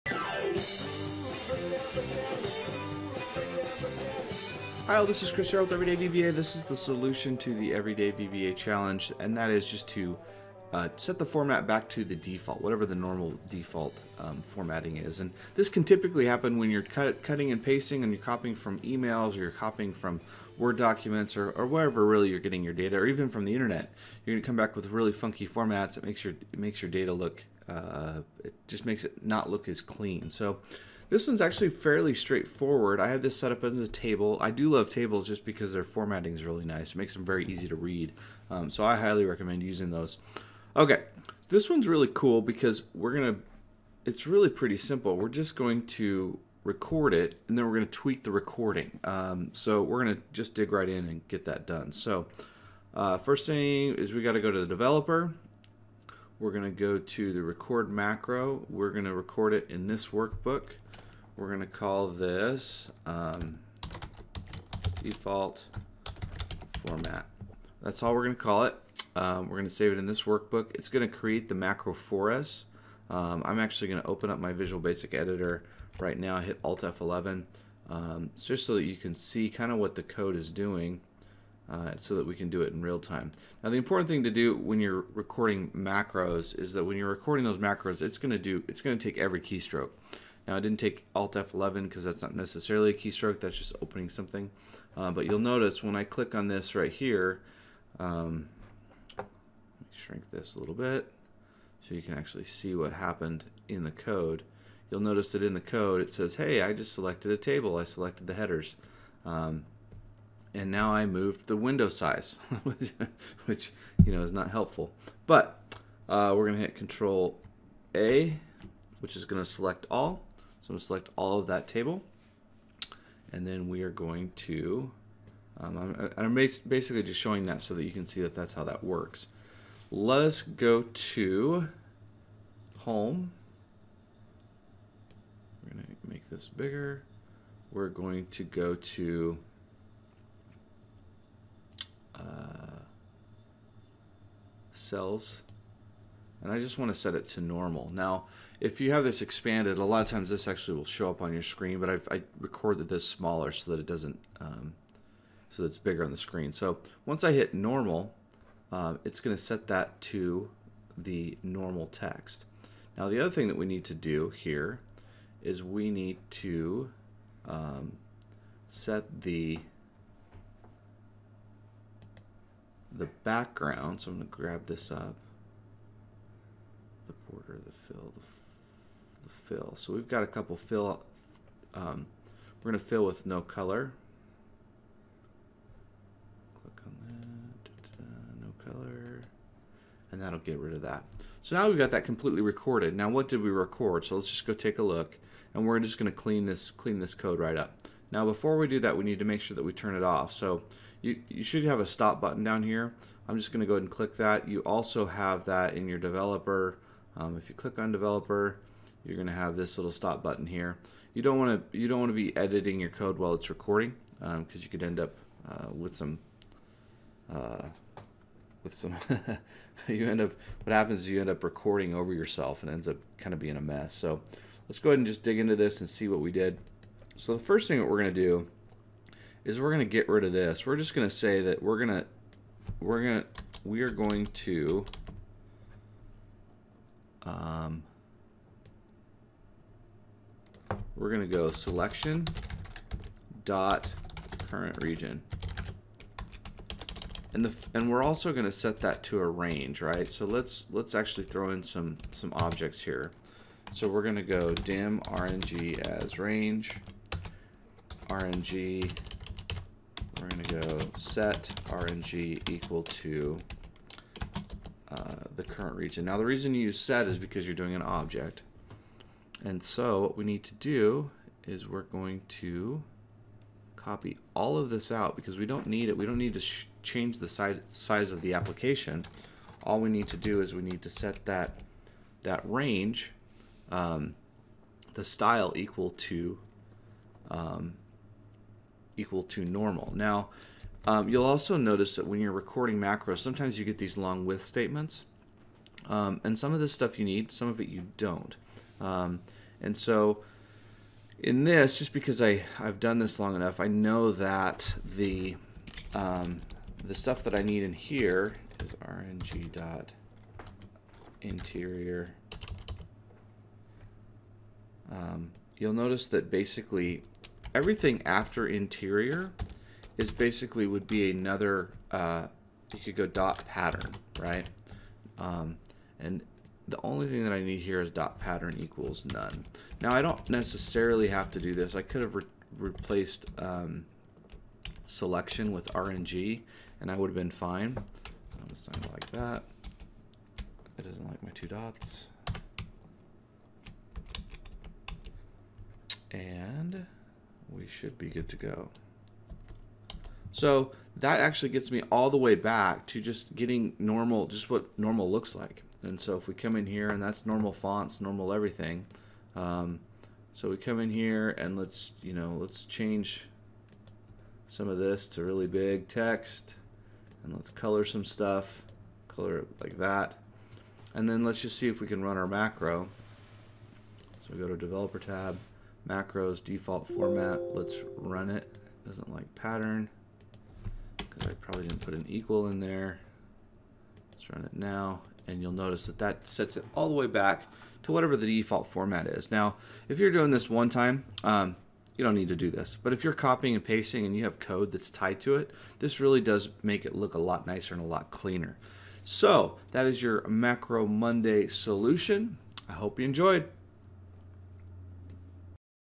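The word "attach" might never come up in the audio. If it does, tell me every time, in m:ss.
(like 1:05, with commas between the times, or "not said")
not said.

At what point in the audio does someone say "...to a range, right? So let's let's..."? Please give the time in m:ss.
4:09.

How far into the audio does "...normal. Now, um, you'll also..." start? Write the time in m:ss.
4:49.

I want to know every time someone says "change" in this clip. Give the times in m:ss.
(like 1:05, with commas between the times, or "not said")
4:36, 6:02.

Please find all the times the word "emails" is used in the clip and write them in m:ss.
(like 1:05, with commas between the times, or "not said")
0:18.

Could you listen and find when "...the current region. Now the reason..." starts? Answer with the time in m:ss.
4:25.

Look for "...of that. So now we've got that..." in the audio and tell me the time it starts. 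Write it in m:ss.
3:10.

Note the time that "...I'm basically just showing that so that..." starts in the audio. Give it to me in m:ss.
2:06.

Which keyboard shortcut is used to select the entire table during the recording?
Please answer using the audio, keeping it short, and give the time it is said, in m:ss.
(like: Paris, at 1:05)
Control A, at 1:56.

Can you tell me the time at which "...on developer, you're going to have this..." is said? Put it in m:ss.
3:27.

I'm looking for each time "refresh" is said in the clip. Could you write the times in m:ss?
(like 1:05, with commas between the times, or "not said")
not said.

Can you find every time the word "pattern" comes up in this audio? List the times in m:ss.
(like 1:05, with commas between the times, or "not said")
5:23, 5:28, 6:19.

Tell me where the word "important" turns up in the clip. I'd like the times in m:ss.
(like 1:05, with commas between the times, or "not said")
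1:23.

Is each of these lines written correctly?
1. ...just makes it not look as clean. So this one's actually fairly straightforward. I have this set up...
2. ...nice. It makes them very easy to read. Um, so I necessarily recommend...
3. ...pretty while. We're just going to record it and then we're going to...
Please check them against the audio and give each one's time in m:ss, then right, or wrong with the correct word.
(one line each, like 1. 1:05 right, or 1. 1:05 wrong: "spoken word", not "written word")
1. 0:28 right
2. 0:36 wrong: "highly", not "necessarily"
3. 0:44 wrong: "simple", not "while".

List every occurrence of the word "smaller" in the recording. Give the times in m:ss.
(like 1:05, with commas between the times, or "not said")
2:33.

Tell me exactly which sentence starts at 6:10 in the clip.
And then let's just see if we can run our macro.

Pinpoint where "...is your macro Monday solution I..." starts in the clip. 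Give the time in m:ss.
6:39.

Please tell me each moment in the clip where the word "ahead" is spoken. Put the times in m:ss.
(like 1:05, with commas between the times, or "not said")
3:23, 3:44.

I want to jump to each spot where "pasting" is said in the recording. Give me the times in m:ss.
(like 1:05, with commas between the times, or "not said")
0:17, 6:33.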